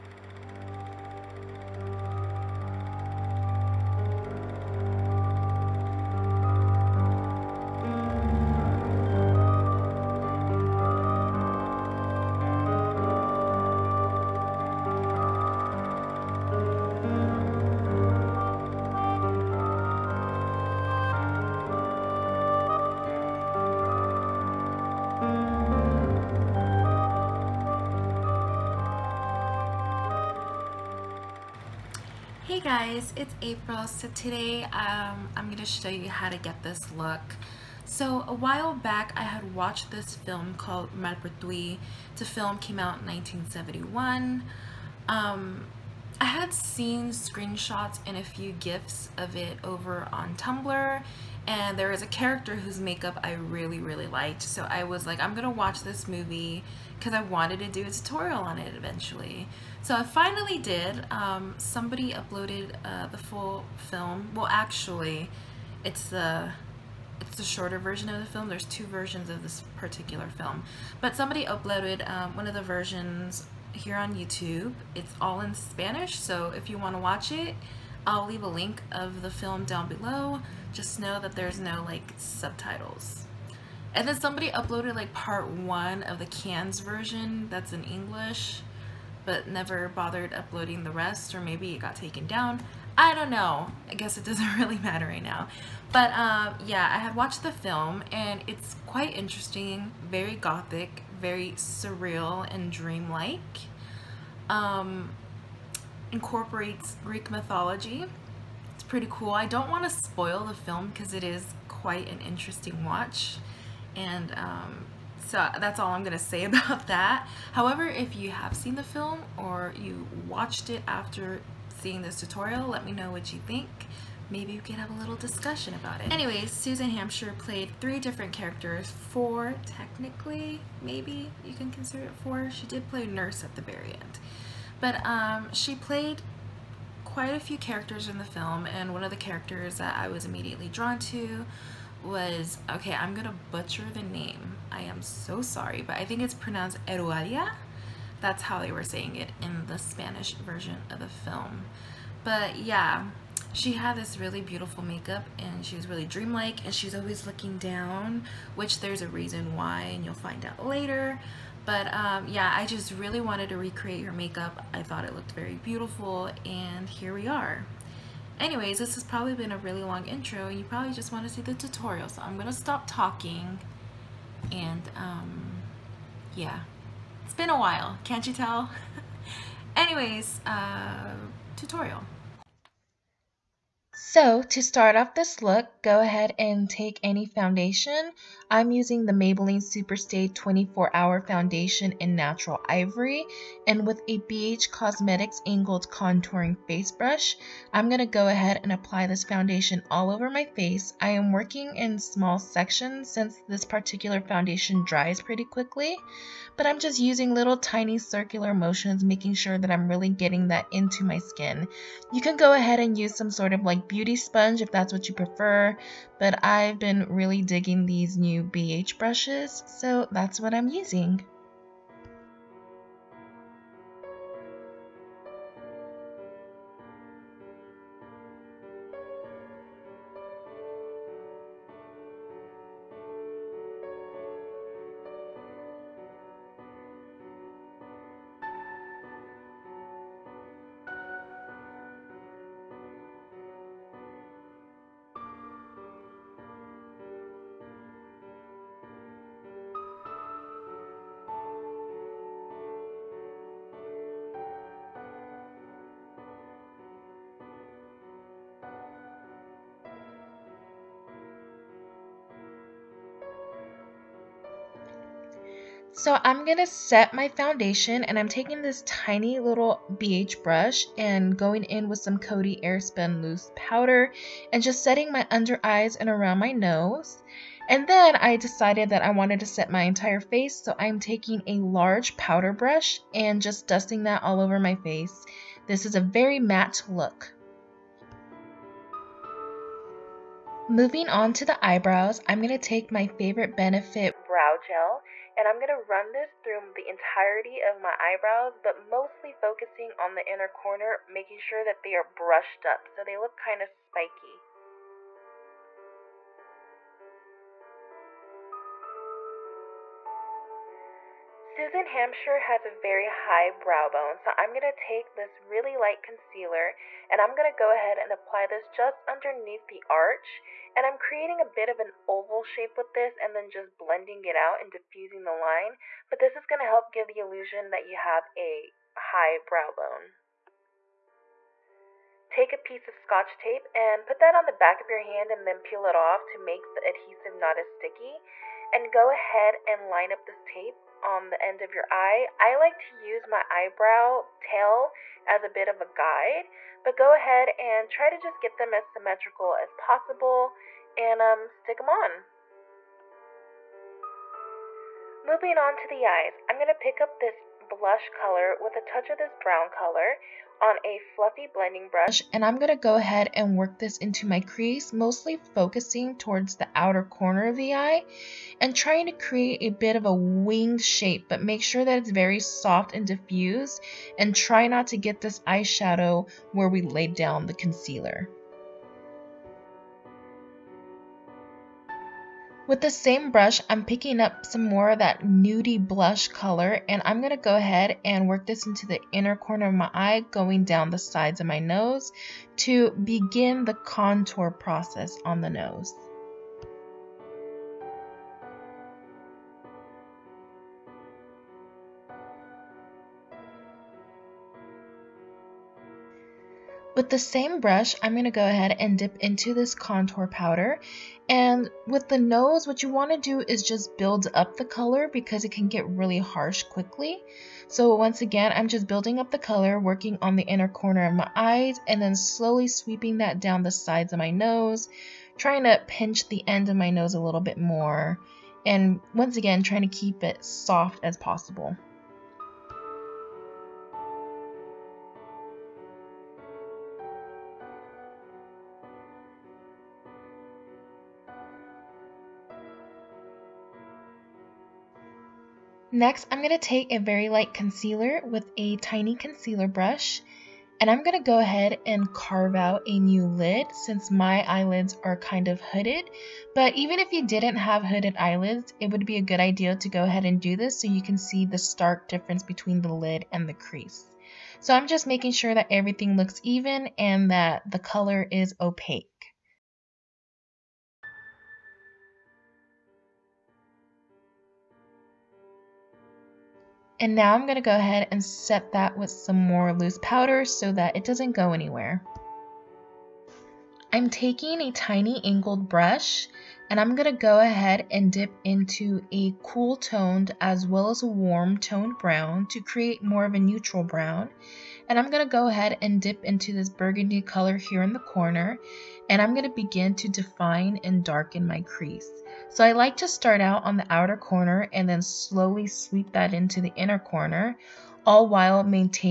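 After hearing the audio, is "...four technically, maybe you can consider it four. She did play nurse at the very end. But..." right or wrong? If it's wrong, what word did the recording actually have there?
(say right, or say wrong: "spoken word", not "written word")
right.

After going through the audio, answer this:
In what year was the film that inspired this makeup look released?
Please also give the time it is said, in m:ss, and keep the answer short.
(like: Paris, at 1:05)
1971, at 0:43.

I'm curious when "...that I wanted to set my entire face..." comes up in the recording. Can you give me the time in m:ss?
4:38.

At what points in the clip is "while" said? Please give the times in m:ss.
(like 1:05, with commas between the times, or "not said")
0:38, 2:57, 8:28.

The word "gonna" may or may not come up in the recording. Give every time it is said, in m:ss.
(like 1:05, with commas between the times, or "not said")
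0:55, 2:23.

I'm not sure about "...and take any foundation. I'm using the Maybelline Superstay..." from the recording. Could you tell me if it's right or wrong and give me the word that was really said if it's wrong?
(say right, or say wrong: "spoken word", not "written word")
right.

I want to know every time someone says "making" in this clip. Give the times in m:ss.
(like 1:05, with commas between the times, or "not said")
3:29, 5:01, 7:45.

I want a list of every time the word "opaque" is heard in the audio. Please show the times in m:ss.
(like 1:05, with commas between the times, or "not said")
7:48.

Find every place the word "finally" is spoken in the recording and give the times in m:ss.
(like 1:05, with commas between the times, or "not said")
1:00.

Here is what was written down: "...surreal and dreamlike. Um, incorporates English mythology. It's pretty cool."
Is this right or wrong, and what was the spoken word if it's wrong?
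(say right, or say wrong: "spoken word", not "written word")
wrong: "Greek", not "English".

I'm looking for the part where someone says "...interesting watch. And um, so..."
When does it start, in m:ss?
1:52.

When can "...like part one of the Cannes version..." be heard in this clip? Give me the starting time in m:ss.
1:24.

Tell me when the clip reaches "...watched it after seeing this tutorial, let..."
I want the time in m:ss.
2:00.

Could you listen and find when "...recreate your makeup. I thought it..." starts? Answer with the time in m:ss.
2:43.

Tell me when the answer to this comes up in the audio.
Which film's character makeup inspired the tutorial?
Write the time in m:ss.
0:40.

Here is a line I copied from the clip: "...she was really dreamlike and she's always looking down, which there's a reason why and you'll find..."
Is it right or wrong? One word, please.
right.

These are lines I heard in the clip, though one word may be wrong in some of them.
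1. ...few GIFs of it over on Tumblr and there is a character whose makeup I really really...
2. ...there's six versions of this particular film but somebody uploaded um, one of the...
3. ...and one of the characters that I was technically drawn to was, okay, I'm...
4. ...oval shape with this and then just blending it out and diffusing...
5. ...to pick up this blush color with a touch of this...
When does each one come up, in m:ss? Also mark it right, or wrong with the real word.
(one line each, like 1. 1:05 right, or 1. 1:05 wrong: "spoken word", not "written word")
1. 0:48 right
2. 1:08 wrong: "two", not "six"
3. 2:18 wrong: "immediately", not "technically"
4. 5:22 right
5. 5:56 right.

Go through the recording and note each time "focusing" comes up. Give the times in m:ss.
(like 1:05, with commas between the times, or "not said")
4:59, 6:05.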